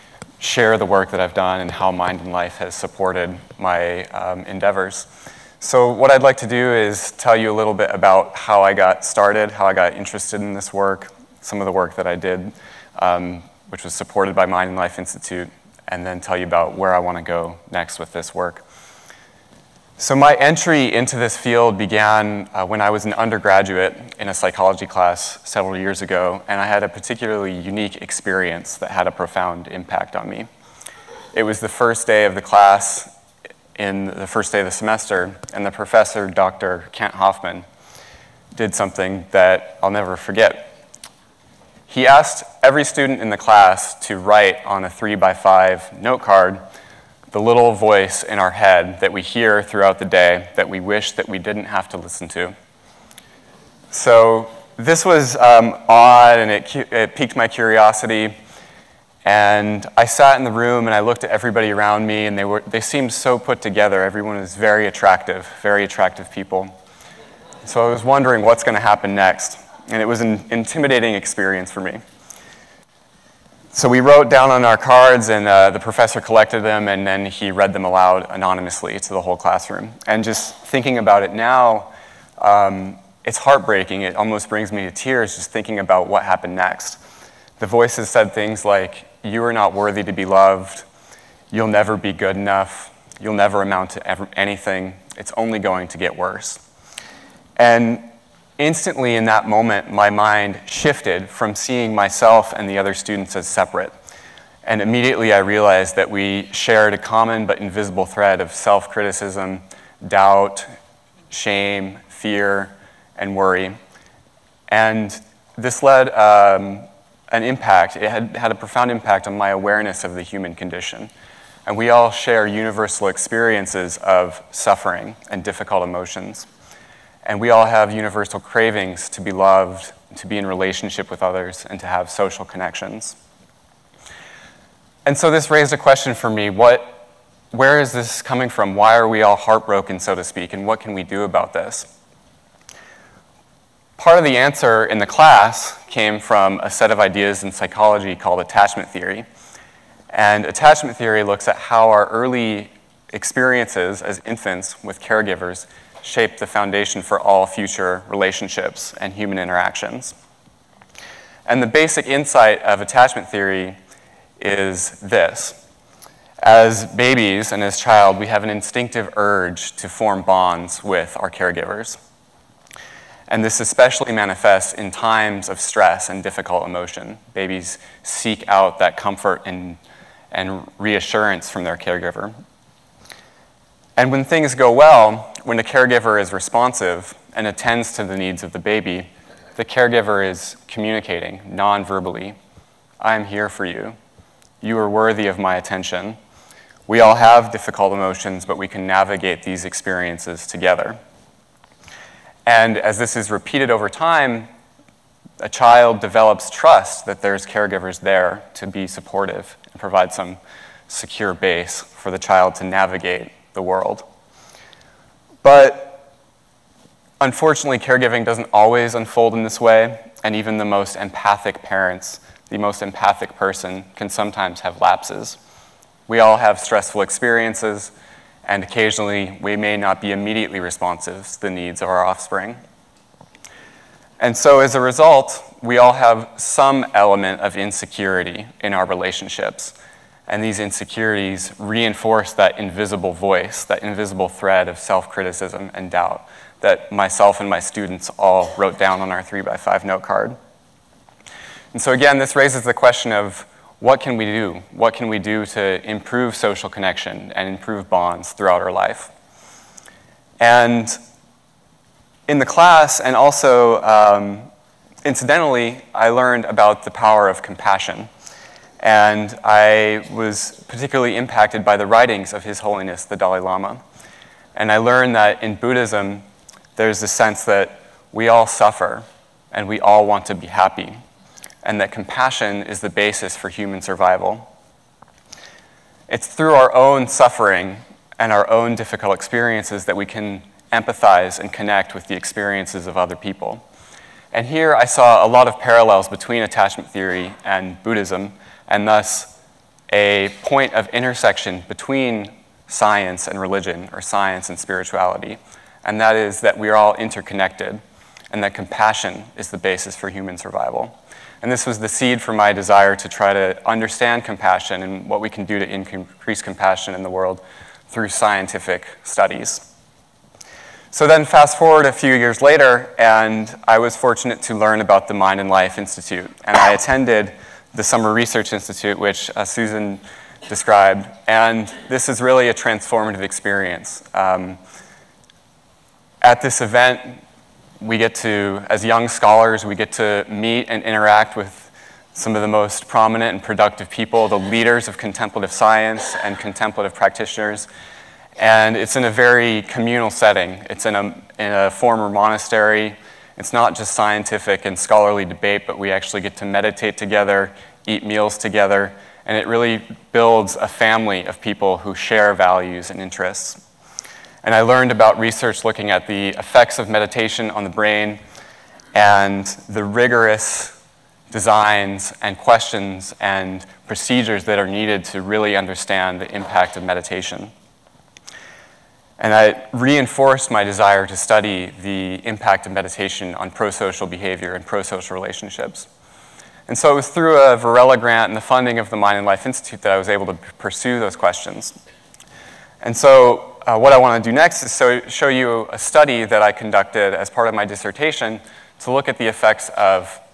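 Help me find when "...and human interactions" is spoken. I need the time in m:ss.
2:38.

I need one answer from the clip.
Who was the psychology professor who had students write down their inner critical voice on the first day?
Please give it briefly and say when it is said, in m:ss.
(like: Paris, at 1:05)
Kent Hoffman, at 0:36.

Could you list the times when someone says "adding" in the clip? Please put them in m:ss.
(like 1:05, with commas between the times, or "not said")
not said.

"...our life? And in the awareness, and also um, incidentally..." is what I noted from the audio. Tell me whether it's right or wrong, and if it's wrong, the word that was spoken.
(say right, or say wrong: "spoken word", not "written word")
wrong: "class", not "awareness".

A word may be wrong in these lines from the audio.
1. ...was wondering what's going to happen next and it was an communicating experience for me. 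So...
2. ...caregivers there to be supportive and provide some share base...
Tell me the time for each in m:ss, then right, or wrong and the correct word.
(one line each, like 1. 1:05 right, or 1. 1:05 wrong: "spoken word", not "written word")
1. 1:07 wrong: "intimidating", not "communicating"
2. 3:27 wrong: "secure", not "share".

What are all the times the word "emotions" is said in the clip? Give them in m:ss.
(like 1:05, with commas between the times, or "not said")
2:05, 2:56, 3:17.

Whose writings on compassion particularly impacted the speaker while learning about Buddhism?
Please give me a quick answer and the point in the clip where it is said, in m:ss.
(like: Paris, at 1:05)
The Dalai Lama, at 4:32.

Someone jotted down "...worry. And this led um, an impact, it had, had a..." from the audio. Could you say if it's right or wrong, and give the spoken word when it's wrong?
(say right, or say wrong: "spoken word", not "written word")
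right.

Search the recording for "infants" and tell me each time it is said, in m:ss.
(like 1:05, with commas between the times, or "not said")
2:34.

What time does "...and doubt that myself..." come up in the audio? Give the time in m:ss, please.
4:05.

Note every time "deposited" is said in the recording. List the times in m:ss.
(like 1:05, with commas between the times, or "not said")
not said.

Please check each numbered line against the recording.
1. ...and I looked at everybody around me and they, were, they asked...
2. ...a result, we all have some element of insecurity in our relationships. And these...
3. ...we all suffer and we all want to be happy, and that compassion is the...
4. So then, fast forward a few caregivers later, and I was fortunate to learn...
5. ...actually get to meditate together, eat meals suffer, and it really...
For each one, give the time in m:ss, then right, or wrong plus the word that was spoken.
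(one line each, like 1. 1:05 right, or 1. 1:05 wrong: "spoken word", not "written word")
1. 1:00 wrong: "seemed", not "asked"
2. 3:54 right
3. 4:38 right
4. 5:20 wrong: "years", not "caregivers"
5. 5:55 wrong: "together", not "suffer".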